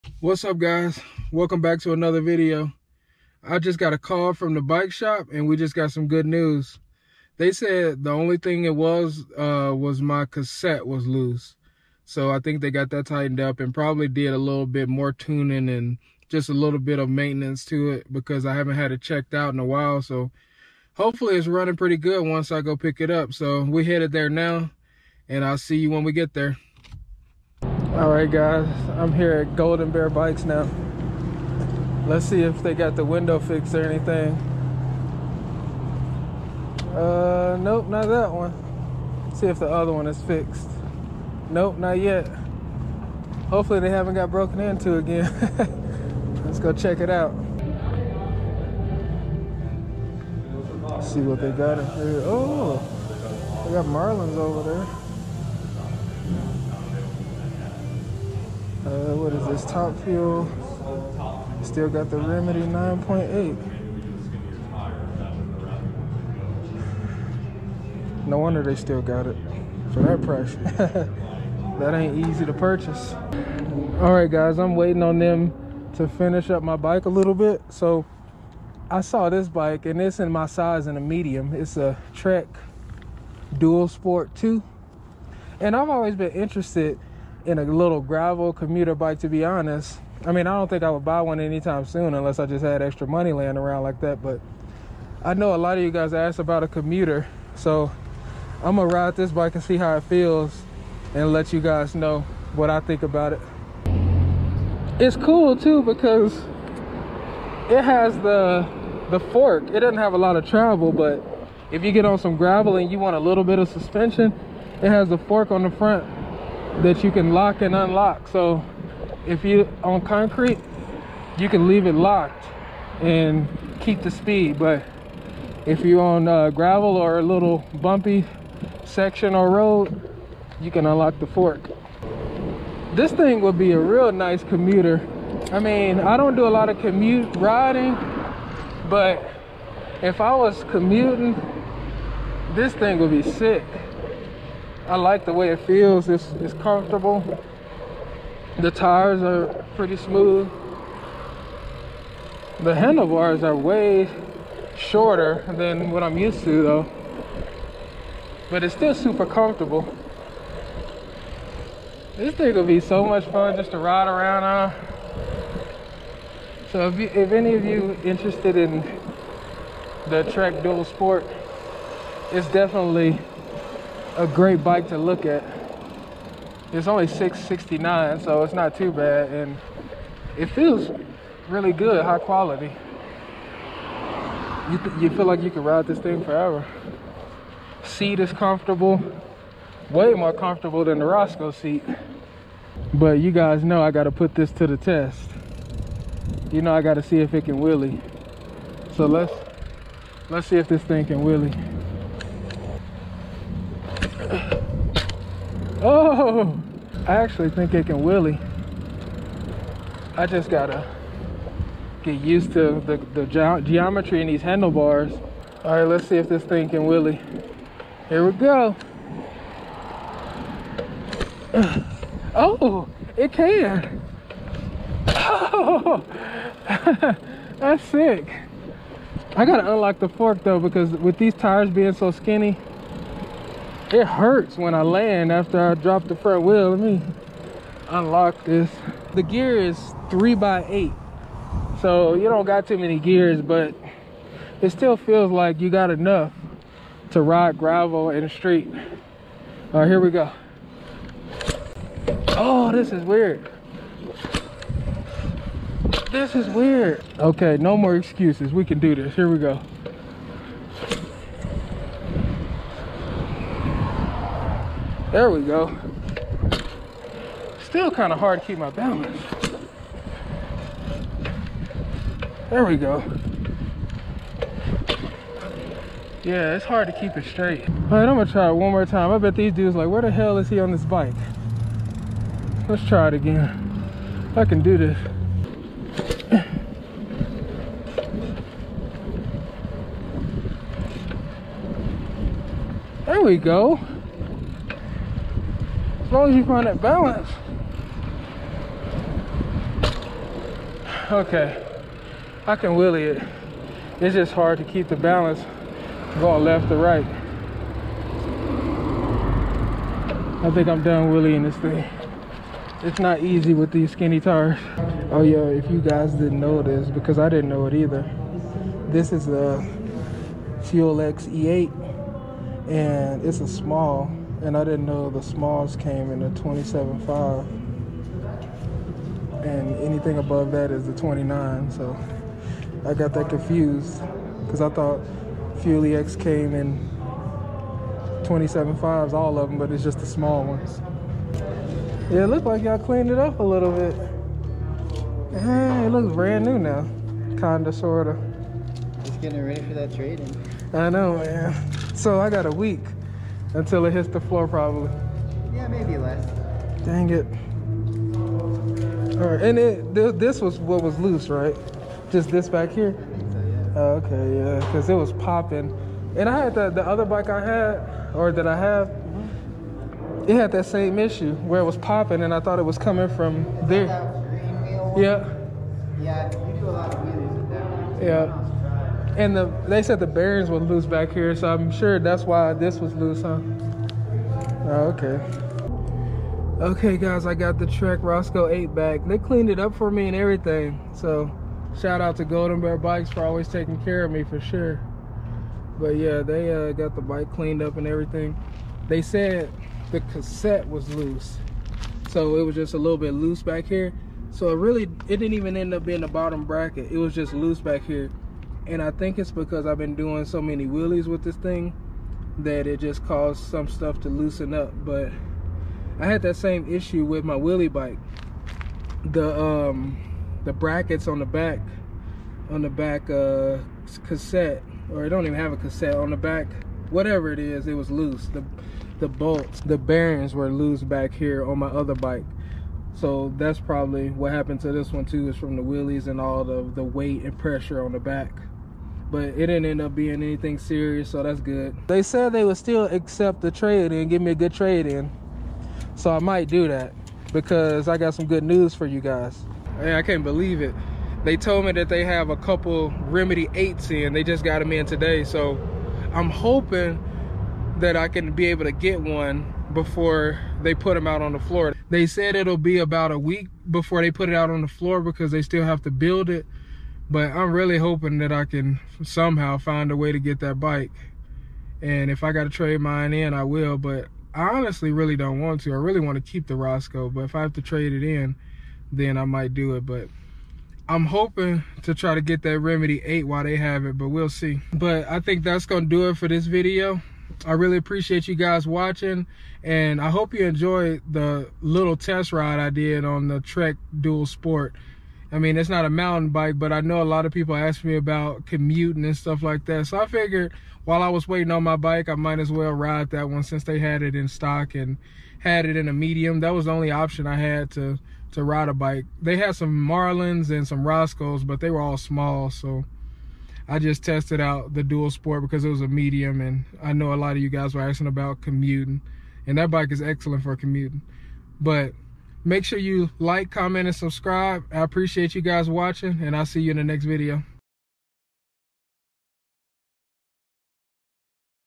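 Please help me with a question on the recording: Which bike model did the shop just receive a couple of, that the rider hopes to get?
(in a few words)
Remedy 8.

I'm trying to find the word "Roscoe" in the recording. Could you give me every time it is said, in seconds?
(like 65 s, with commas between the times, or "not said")
191 s, 388 s, 476 s, 510 s.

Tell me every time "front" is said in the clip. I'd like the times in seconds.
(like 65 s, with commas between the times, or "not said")
115 s, 236 s.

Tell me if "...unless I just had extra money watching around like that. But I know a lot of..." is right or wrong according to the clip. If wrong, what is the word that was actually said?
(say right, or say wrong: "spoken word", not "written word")
wrong: "laying", not "watching".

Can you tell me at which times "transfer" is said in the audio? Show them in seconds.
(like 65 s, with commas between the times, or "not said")
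not said.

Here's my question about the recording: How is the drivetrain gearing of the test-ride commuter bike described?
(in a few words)
3 by 8.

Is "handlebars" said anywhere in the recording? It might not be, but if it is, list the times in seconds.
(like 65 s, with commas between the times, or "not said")
152 s, 214 s.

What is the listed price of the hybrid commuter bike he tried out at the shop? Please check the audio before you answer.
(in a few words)
669.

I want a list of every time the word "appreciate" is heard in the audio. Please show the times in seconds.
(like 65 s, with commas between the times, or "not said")
487 s, 524 s.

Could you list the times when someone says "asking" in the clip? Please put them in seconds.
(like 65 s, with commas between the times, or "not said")
517 s.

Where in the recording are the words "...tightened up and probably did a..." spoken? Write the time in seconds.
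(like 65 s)
13 s.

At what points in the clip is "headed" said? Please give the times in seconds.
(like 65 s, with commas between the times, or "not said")
23 s.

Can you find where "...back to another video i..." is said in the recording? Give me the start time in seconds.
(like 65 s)
1 s.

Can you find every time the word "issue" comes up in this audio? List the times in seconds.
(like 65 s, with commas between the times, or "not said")
370 s, 416 s.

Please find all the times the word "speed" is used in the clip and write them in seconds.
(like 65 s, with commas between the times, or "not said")
124 s.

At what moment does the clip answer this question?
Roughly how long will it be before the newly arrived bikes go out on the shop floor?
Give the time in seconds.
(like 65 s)
462 s.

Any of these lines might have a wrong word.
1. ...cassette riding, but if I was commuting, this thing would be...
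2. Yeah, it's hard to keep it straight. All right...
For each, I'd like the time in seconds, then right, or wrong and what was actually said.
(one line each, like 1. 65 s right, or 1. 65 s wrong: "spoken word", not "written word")
1. 136 s wrong: "commute", not "cassette"
2. 276 s right.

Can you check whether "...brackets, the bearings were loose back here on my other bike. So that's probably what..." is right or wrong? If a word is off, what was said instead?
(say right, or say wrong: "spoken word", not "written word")
wrong: "bolts", not "brackets".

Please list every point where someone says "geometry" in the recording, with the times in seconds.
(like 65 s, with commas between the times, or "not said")
213 s.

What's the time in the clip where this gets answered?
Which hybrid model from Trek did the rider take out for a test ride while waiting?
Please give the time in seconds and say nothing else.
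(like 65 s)
82 s.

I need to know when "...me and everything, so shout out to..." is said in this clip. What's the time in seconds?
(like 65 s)
389 s.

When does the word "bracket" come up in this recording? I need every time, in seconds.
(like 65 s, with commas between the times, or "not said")
406 s, 420 s.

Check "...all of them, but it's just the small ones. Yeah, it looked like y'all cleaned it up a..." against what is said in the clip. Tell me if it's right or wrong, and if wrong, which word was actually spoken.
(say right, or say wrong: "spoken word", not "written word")
right.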